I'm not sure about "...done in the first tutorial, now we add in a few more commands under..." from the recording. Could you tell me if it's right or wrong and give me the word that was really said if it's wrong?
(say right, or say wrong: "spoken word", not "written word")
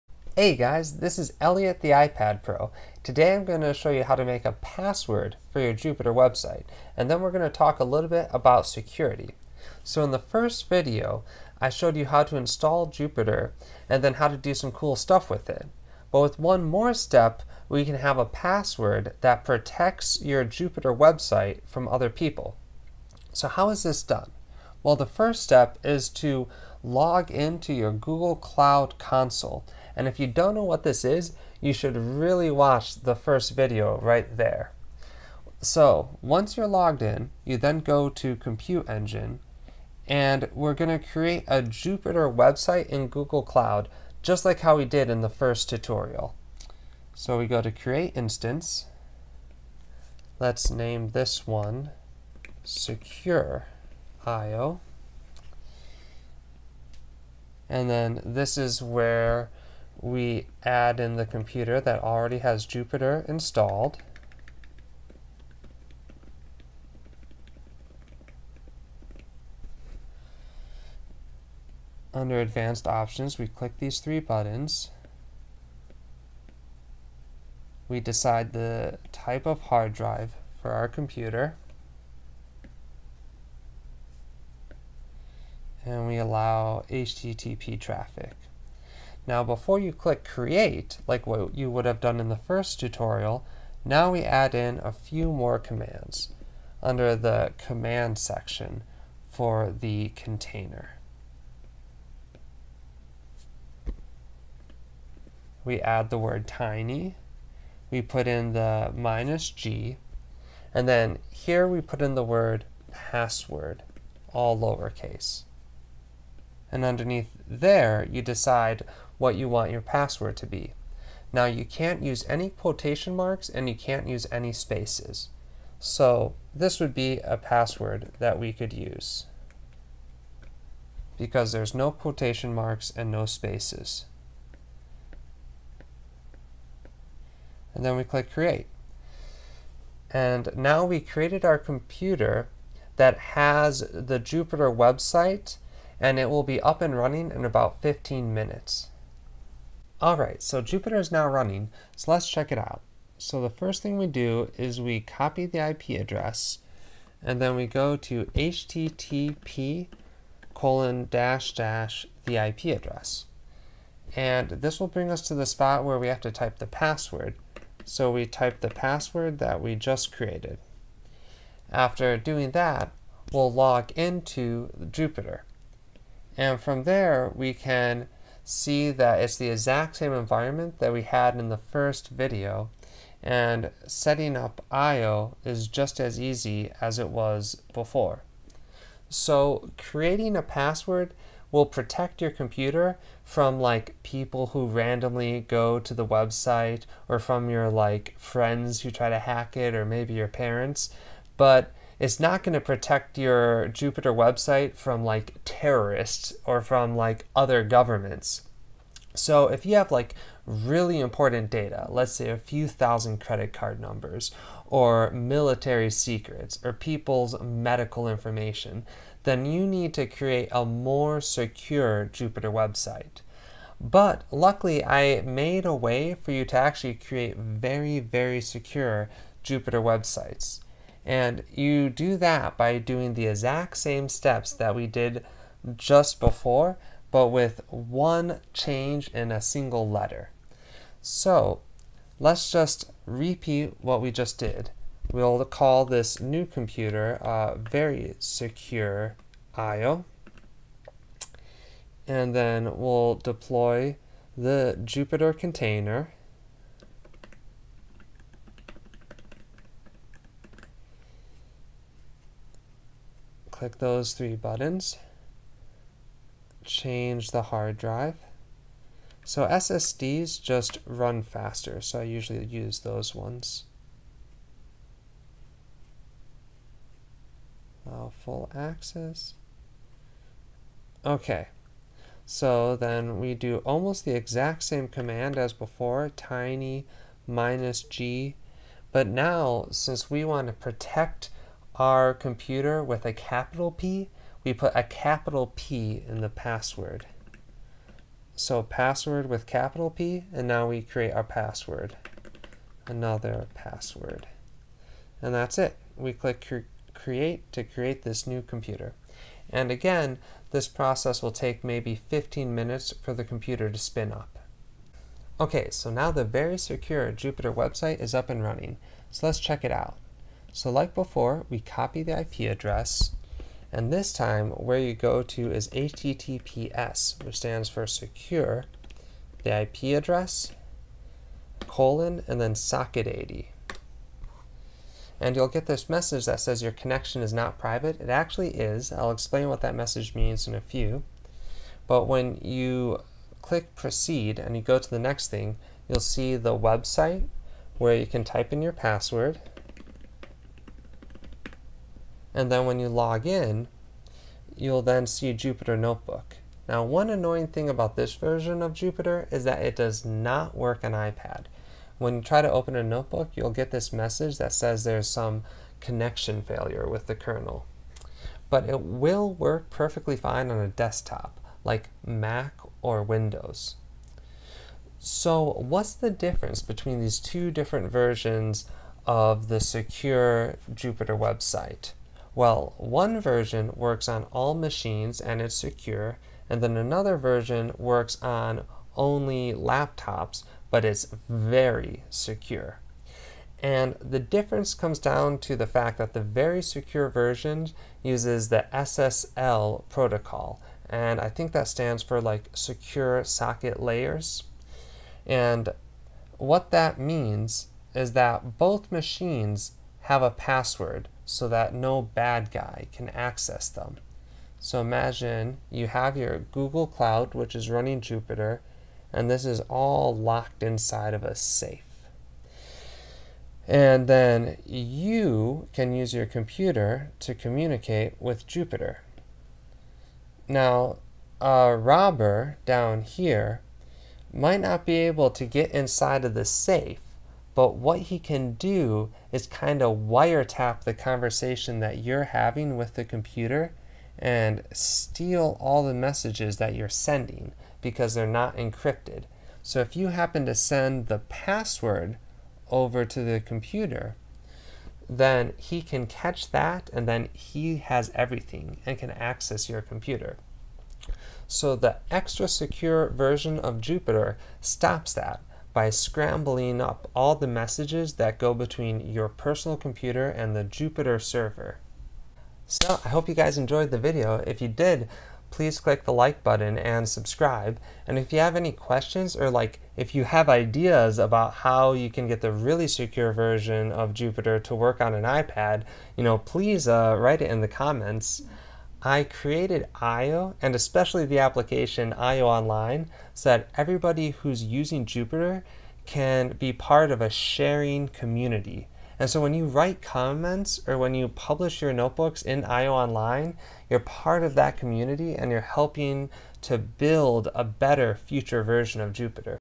right.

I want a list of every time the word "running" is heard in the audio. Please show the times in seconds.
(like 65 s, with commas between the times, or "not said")
146 s, 151 s, 318 s, 417 s.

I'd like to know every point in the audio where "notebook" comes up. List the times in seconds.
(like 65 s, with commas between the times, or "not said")
355 s, 362 s, 501 s.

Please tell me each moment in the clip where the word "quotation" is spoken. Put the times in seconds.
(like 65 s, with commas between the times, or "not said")
122 s, 131 s.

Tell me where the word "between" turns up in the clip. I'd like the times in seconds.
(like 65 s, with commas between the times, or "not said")
376 s, 468 s.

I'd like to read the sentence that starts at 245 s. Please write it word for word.
We'll call this new computer uh, very secure IO.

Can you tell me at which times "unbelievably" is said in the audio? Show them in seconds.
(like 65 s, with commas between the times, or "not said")
not said.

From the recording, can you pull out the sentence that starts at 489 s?
I created IO and especially the application IO Online so that everybody who's using Jupyter can be part of a sharing community.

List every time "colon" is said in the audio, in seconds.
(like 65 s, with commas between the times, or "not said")
160 s, 331 s.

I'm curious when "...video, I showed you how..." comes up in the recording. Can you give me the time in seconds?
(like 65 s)
10 s.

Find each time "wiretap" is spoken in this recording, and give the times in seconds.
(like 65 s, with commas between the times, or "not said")
439 s.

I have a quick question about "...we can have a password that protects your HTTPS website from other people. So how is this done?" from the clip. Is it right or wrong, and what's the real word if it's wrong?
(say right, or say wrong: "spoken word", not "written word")
wrong: "Jupyter", not "HTTPS".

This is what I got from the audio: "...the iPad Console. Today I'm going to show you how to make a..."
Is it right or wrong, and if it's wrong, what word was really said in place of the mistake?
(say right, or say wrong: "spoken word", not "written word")
wrong: "Pro", not "Console".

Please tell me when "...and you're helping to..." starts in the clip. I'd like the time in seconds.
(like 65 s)
505 s.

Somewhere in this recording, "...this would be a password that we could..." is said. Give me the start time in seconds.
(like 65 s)
126 s.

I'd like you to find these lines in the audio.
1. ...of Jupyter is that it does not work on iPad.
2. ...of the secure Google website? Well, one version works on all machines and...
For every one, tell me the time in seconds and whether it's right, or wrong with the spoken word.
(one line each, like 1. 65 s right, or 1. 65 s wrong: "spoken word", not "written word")
1. 358 s right
2. 379 s wrong: "Jupyter", not "Google".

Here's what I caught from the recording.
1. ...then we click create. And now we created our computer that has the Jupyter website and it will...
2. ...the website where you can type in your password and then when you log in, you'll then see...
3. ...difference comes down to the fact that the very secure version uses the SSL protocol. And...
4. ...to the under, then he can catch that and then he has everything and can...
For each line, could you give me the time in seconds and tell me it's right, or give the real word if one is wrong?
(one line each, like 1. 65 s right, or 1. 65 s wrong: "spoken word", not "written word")
1. 137 s right
2. 346 s right
3. 394 s right
4. 453 s wrong: "computer", not "under".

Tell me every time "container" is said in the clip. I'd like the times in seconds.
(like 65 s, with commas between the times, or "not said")
100 s, 255 s.